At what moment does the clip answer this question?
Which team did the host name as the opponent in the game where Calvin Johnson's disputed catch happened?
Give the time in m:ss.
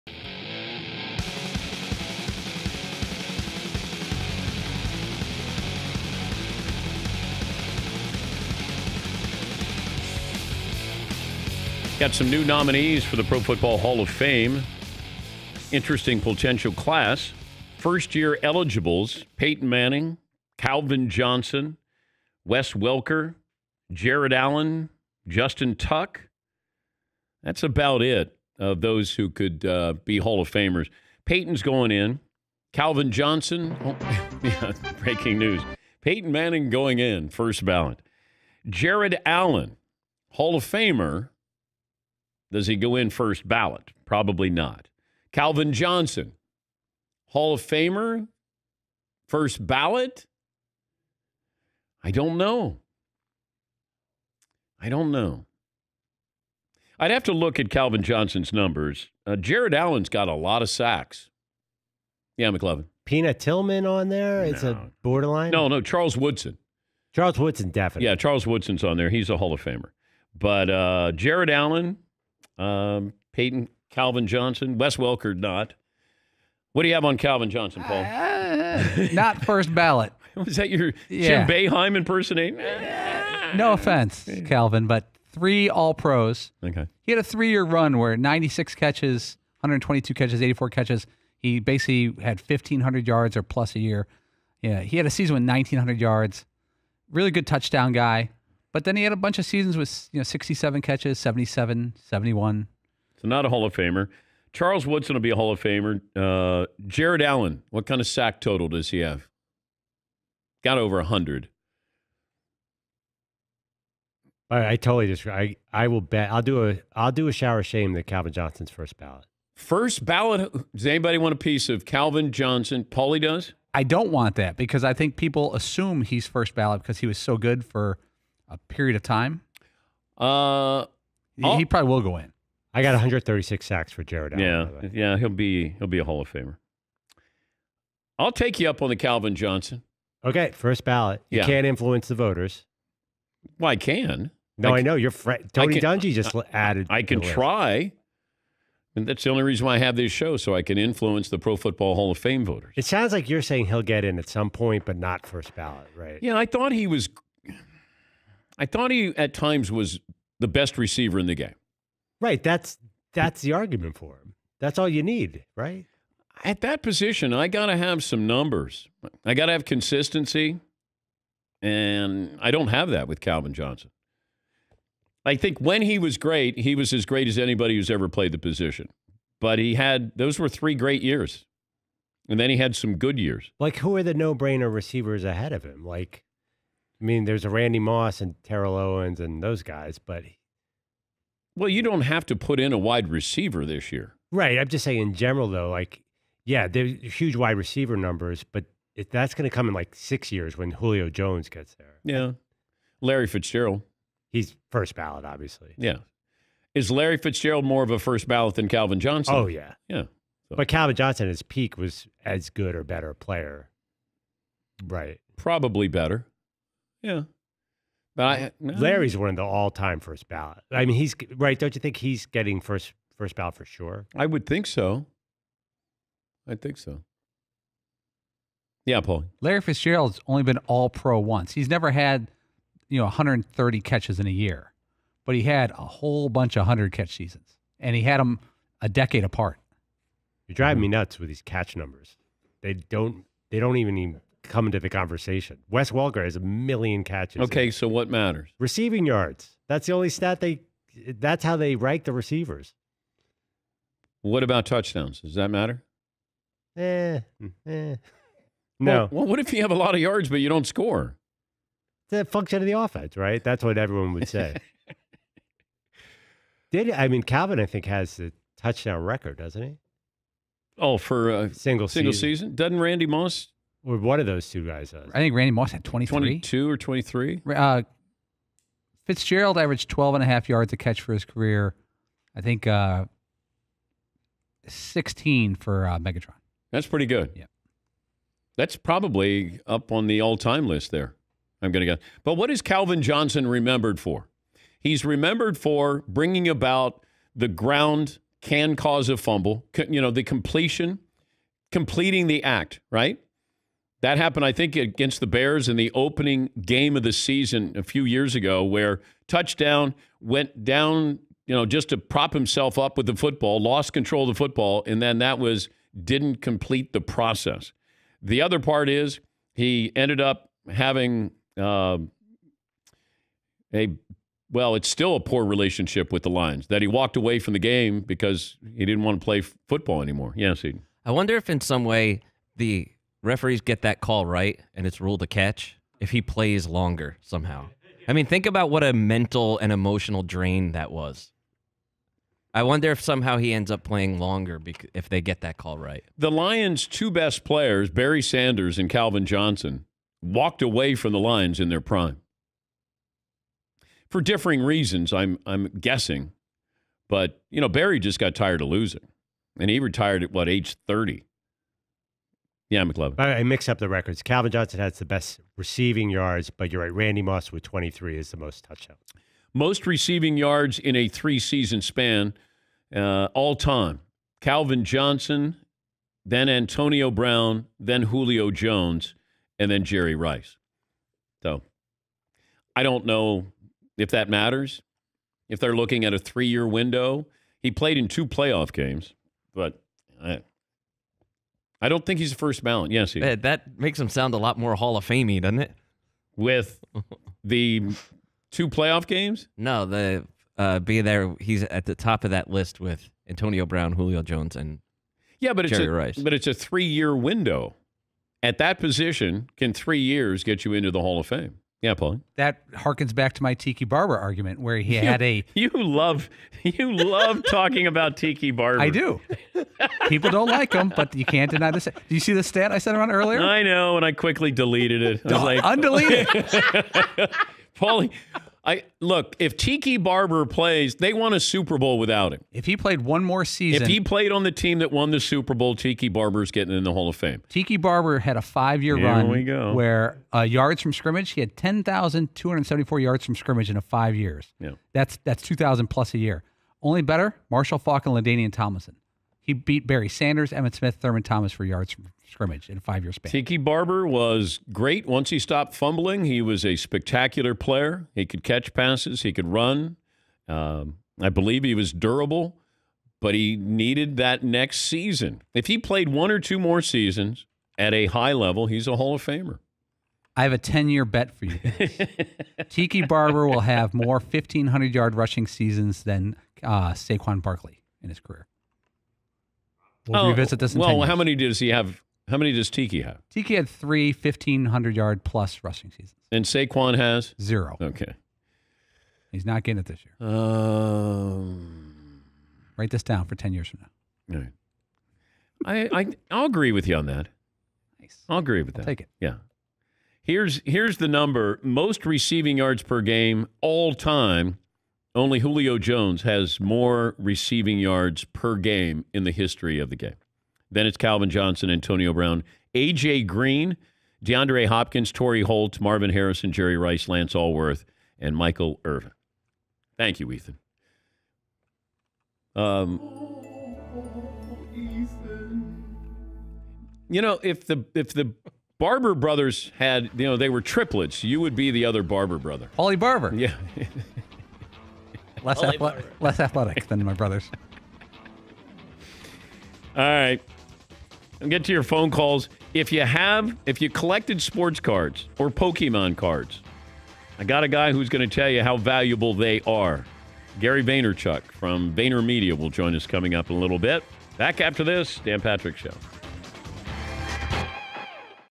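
5:05.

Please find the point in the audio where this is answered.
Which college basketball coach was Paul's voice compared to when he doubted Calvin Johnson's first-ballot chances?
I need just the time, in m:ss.
1:21.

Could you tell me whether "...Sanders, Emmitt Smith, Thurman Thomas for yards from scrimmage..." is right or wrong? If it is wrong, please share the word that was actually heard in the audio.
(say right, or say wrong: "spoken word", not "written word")
right.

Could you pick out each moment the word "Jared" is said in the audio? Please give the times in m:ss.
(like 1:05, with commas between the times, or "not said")
0:23, 0:38, 0:59, 1:11, 1:46, 2:14.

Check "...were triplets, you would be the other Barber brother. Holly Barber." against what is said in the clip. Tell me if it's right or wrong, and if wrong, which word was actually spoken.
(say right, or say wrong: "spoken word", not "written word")
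right.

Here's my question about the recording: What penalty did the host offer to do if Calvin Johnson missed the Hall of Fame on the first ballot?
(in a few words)
shower of shame.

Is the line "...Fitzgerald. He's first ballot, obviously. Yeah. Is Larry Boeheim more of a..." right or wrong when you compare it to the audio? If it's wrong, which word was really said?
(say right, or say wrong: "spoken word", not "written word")
wrong: "Fitzgerald", not "Boeheim".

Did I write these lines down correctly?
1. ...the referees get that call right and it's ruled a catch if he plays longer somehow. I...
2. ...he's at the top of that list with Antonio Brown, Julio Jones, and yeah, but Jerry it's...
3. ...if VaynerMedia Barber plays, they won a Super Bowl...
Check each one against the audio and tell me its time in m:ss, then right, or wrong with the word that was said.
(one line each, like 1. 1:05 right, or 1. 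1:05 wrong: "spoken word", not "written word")
1. 5:32 right
2. 6:41 right
3. 7:09 wrong: "Tiki", not "VaynerMedia".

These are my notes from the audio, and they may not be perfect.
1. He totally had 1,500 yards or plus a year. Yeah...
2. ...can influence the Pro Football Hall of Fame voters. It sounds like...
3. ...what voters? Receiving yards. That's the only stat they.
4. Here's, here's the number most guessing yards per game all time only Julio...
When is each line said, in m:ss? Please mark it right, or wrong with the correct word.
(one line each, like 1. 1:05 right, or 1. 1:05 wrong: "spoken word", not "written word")
1. 1:31 wrong: "basically", not "totally"
2. 2:30 right
3. 4:07 wrong: "matters", not "voters"
4. 8:20 wrong: "receiving", not "guessing".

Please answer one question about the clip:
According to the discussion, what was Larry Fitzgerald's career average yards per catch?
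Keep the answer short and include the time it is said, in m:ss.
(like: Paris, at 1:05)
12.5, at 4:39.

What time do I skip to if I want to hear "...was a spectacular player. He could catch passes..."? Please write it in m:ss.
7:36.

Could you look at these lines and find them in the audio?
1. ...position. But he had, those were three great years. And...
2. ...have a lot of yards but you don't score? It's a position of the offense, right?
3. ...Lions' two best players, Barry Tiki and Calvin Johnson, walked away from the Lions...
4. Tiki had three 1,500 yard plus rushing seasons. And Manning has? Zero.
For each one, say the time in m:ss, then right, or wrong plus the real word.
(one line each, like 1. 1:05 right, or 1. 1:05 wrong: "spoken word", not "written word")
1. 2:58 right
2. 4:19 wrong: "function", not "position"
3. 5:46 wrong: "Sanders", not "Tiki"
4. 8:03 wrong: "Saquon", not "Manning".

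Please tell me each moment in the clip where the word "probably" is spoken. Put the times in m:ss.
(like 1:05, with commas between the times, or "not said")
0:44, 2:11, 3:35, 4:48.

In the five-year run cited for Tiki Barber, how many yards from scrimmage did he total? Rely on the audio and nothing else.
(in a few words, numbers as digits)
10,274.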